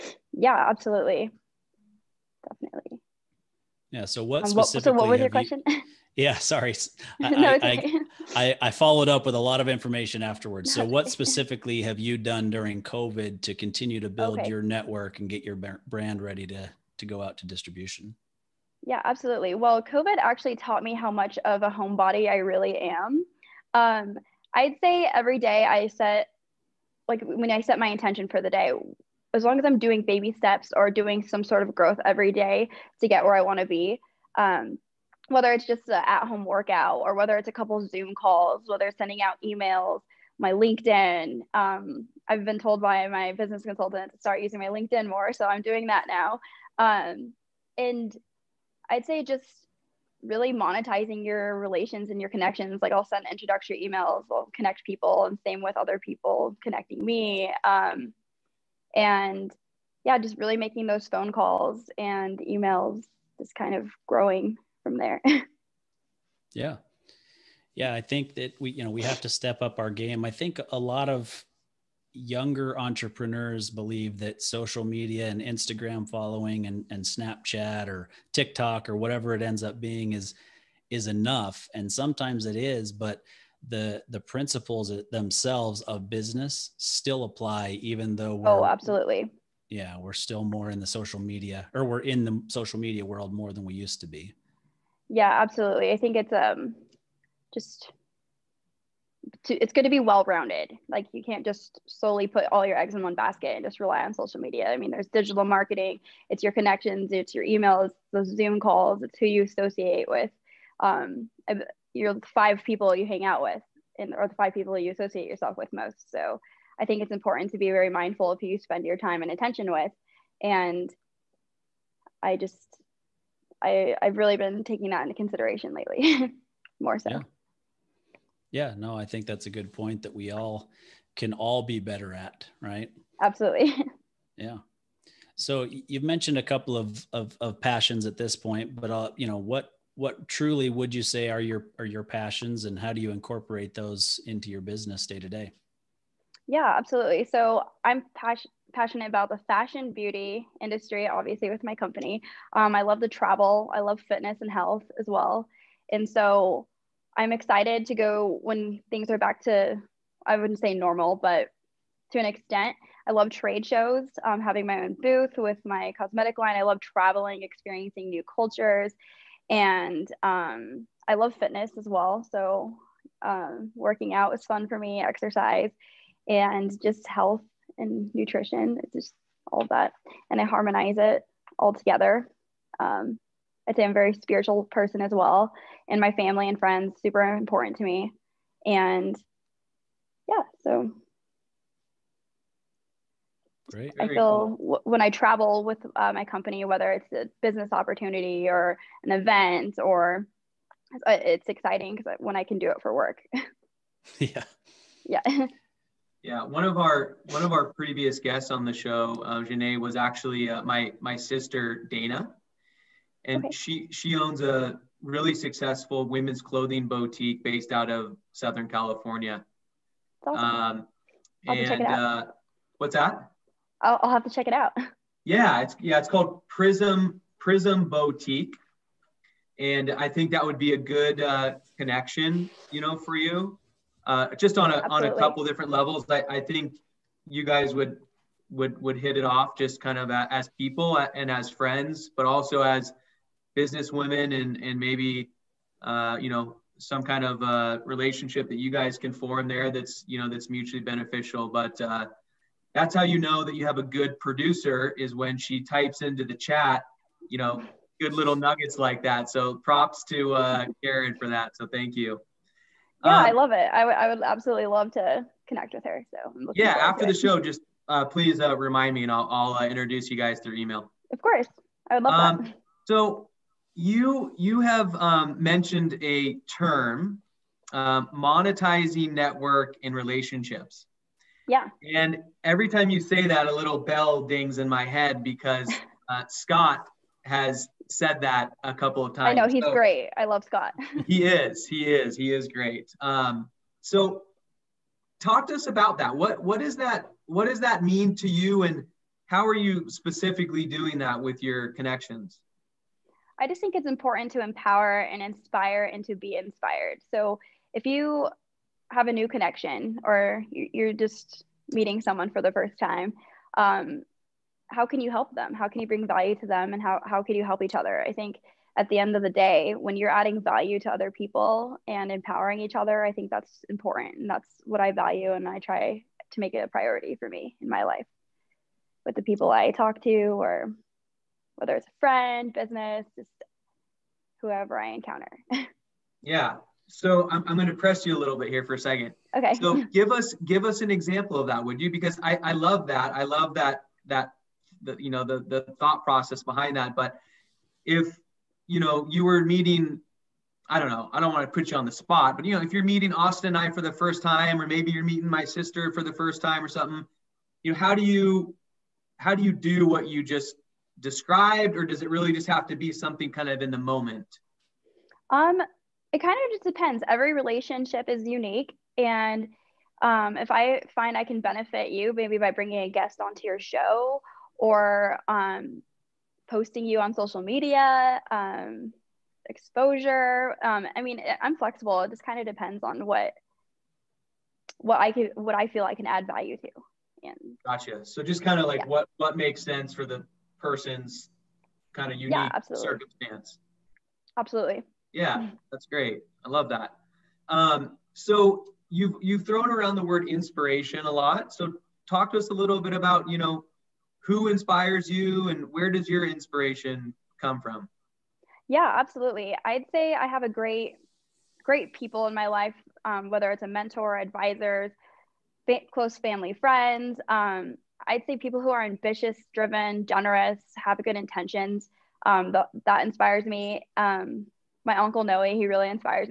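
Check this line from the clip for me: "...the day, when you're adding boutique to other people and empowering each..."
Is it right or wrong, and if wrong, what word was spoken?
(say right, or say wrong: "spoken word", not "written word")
wrong: "value", not "boutique".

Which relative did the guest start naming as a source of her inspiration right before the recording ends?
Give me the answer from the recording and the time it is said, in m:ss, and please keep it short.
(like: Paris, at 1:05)
uncle Noe, at 7:04.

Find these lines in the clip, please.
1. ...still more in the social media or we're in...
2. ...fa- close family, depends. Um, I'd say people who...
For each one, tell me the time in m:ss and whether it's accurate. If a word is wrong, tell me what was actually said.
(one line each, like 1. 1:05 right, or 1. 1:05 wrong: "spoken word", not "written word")
1. 1:30 right
2. 6:55 wrong: "friends", not "depends".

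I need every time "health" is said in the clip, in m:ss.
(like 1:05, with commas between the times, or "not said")
2:34, 2:57.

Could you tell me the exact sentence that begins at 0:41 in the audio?
Um, I've been told by my business consultant to start using my LinkedIn more, so I'm doing that now.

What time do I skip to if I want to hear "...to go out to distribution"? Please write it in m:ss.
0:16.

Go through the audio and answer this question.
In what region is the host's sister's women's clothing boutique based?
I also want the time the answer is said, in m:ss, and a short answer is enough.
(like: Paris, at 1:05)
Southern California, at 3:38.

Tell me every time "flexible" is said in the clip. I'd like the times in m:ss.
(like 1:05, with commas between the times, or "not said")
6:21.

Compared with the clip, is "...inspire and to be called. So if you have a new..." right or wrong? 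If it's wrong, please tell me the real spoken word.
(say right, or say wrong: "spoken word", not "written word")
wrong: "inspired", not "called".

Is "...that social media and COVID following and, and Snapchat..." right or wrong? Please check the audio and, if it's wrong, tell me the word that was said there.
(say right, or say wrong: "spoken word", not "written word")
wrong: "Instagram", not "COVID".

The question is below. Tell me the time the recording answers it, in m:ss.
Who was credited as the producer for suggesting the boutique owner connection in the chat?
4:20.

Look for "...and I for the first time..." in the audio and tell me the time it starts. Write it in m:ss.
5:53.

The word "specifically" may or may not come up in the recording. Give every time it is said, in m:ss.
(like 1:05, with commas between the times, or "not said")
0:04, 0:11, 4:59.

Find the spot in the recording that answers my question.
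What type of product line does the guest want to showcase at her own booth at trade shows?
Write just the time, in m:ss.
2:45.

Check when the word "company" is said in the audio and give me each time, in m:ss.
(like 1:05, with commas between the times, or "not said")
2:31, 3:16.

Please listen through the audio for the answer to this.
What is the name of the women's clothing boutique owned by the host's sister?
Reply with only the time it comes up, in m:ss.
3:47.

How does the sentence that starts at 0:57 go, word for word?
Um, and yeah, just really making those phone calls and emails, just kind of growing from there.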